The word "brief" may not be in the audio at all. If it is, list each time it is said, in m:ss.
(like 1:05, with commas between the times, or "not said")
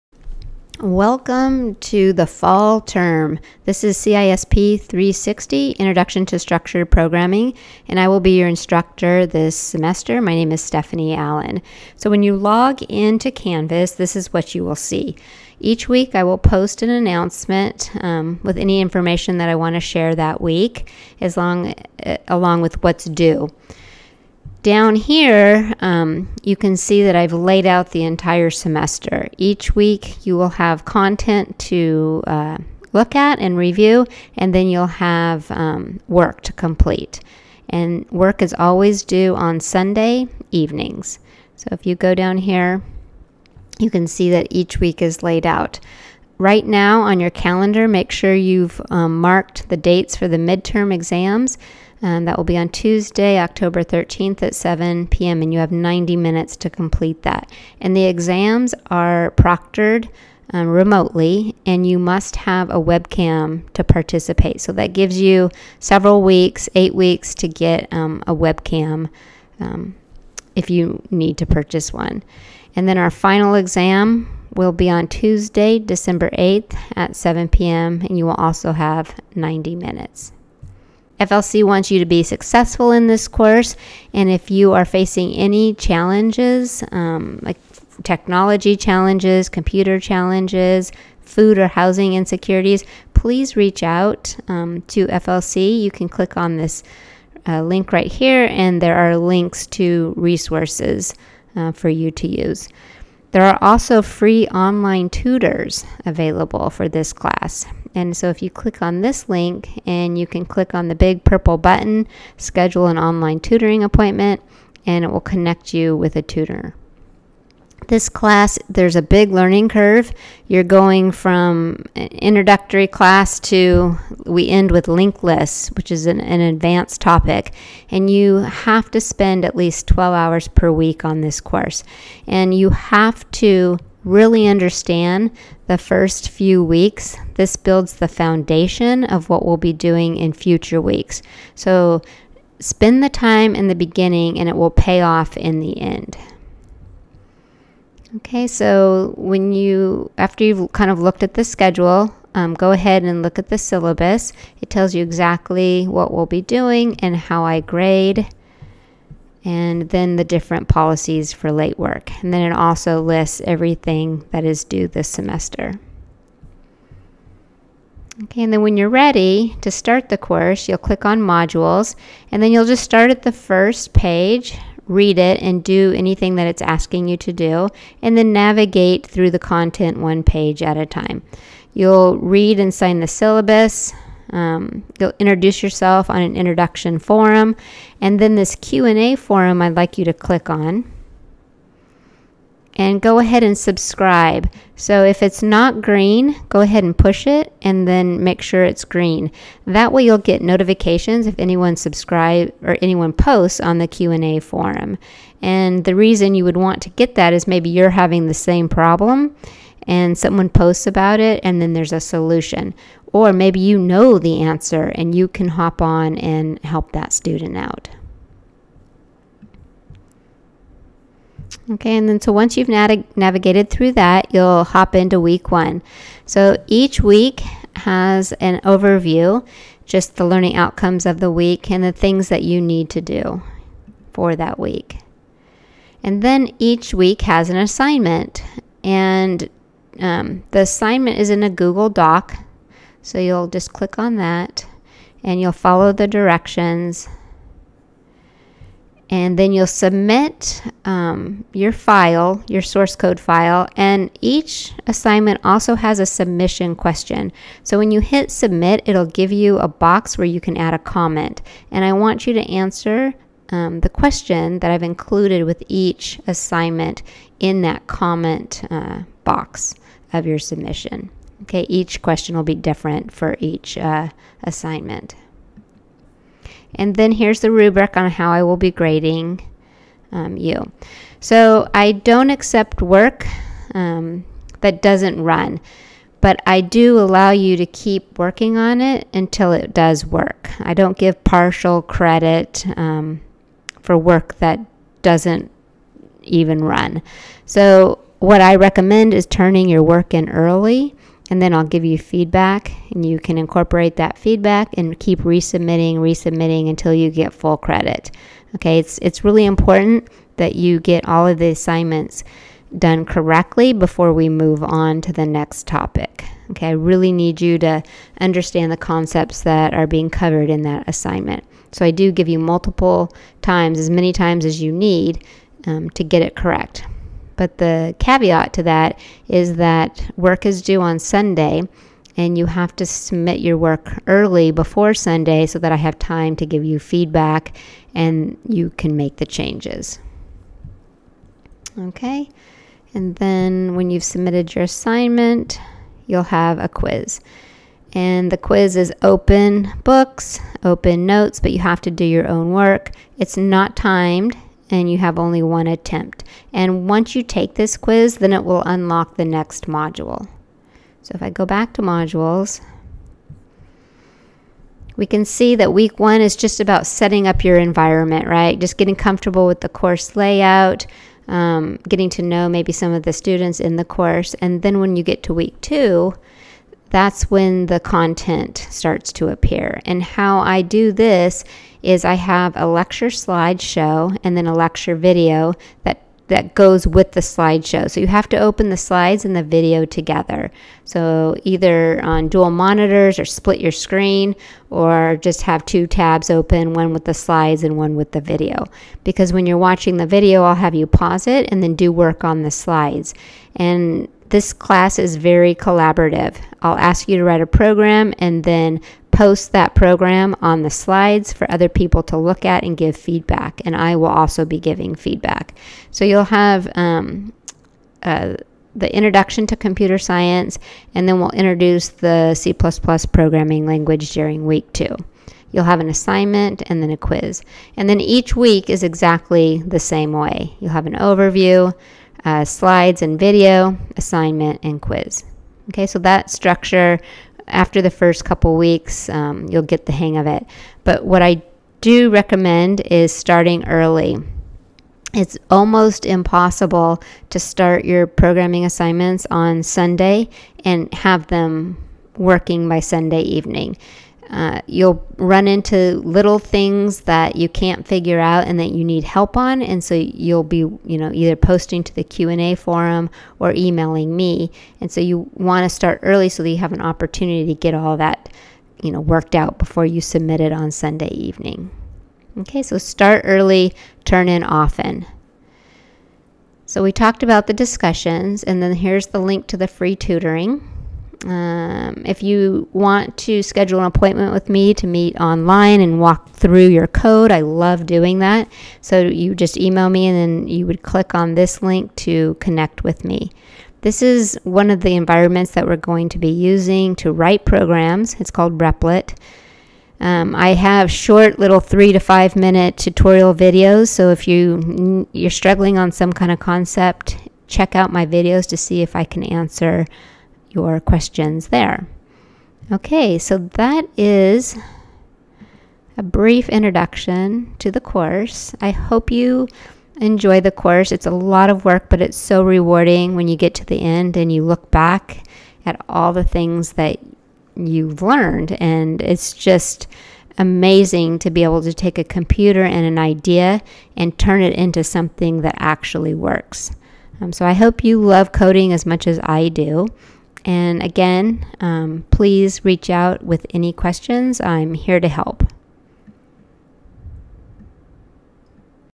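8:36.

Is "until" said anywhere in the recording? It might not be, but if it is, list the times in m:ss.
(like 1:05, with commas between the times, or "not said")
4:49, 5:06.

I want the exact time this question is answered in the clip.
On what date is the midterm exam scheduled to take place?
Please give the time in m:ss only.
0:52.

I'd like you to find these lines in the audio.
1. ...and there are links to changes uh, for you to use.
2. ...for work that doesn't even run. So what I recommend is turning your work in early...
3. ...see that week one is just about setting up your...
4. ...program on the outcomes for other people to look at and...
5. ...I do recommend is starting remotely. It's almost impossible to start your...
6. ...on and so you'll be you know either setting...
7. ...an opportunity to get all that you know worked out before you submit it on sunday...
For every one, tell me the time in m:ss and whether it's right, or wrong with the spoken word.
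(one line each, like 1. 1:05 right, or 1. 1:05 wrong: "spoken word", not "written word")
1. 1:38 wrong: "resources", not "changes"
2. 4:53 right
3. 6:05 right
4. 6:49 wrong: "slides", not "outcomes"
5. 7:21 wrong: "early", not "remotely"
6. 7:39 wrong: "posting", not "setting"
7. 7:46 right.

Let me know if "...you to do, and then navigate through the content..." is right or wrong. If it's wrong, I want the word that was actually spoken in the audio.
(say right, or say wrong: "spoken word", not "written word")
right.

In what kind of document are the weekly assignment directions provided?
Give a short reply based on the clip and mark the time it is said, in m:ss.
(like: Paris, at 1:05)
Google Doc, at 4:01.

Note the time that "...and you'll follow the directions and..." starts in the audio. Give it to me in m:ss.
4:05.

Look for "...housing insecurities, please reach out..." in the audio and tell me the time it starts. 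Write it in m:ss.
1:31.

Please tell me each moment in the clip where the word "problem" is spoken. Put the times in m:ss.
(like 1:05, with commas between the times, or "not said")
3:28.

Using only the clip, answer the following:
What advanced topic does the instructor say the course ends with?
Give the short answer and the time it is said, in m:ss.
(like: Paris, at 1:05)
Linked lists, at 2:04.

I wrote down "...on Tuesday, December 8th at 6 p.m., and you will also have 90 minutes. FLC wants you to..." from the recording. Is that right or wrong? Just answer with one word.
wrong.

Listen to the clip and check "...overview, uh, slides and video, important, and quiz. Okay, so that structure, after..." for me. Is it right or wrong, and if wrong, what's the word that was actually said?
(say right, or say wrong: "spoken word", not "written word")
wrong: "assignment", not "important".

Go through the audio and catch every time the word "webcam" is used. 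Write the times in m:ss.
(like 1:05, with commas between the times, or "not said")
1:02, 1:08.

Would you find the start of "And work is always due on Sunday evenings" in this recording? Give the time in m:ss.
0:37.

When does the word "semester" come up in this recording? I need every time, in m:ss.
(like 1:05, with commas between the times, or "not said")
0:09, 0:28, 2:45.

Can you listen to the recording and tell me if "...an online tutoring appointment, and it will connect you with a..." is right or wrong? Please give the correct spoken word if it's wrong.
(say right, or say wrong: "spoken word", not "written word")
right.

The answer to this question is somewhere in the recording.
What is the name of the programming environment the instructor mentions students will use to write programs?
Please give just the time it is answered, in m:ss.
8:18.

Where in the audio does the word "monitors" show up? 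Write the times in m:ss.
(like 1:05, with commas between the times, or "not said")
6:32.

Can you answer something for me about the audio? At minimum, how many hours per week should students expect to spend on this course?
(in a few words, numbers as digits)
12.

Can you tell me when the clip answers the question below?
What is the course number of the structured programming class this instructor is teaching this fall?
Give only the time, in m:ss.
0:03.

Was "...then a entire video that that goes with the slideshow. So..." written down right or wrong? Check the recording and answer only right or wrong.
wrong.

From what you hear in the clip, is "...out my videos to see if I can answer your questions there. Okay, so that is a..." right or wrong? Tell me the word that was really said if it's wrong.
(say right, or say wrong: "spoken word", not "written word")
right.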